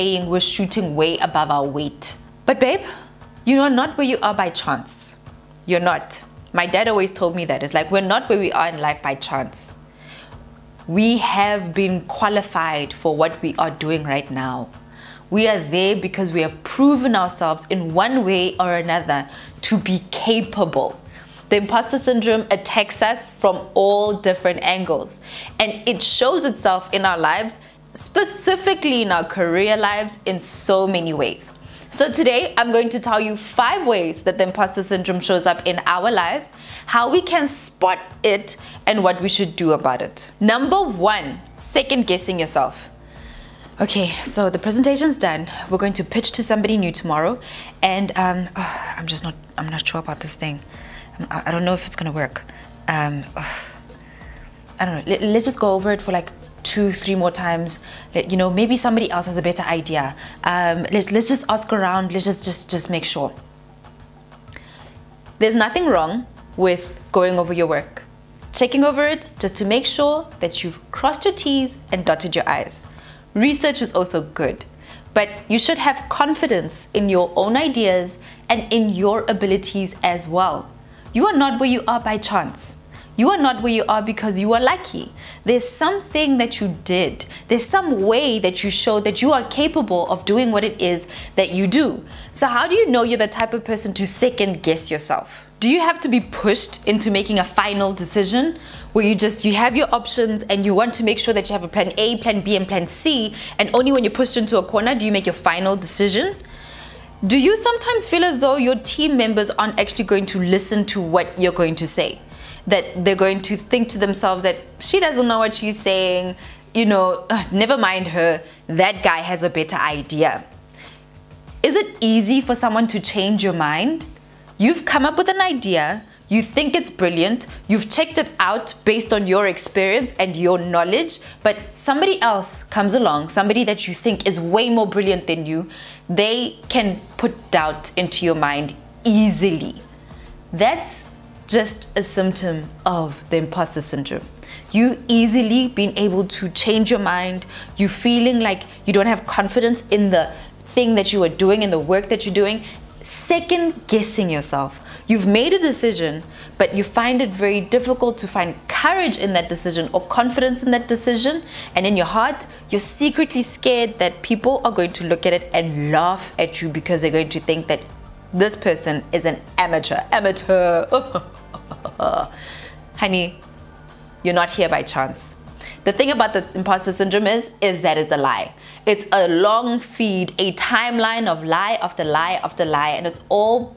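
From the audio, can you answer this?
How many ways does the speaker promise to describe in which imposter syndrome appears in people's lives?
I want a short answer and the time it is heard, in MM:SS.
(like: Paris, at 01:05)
5, at 00:33.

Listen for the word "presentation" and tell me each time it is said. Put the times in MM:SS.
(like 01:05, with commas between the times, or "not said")
00:44.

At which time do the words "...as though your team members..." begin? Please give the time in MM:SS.
01:48.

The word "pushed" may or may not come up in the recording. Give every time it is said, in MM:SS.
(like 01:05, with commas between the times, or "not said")
01:36, 01:44.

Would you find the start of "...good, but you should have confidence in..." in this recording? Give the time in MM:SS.
01:14.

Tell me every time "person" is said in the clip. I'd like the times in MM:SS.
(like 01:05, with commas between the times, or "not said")
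01:33, 02:48.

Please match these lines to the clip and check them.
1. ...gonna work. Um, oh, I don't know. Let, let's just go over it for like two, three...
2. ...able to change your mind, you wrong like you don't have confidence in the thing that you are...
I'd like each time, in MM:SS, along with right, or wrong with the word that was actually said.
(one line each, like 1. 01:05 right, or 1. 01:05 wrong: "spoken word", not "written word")
1. 00:51 right
2. 02:25 wrong: "feeling", not "wrong".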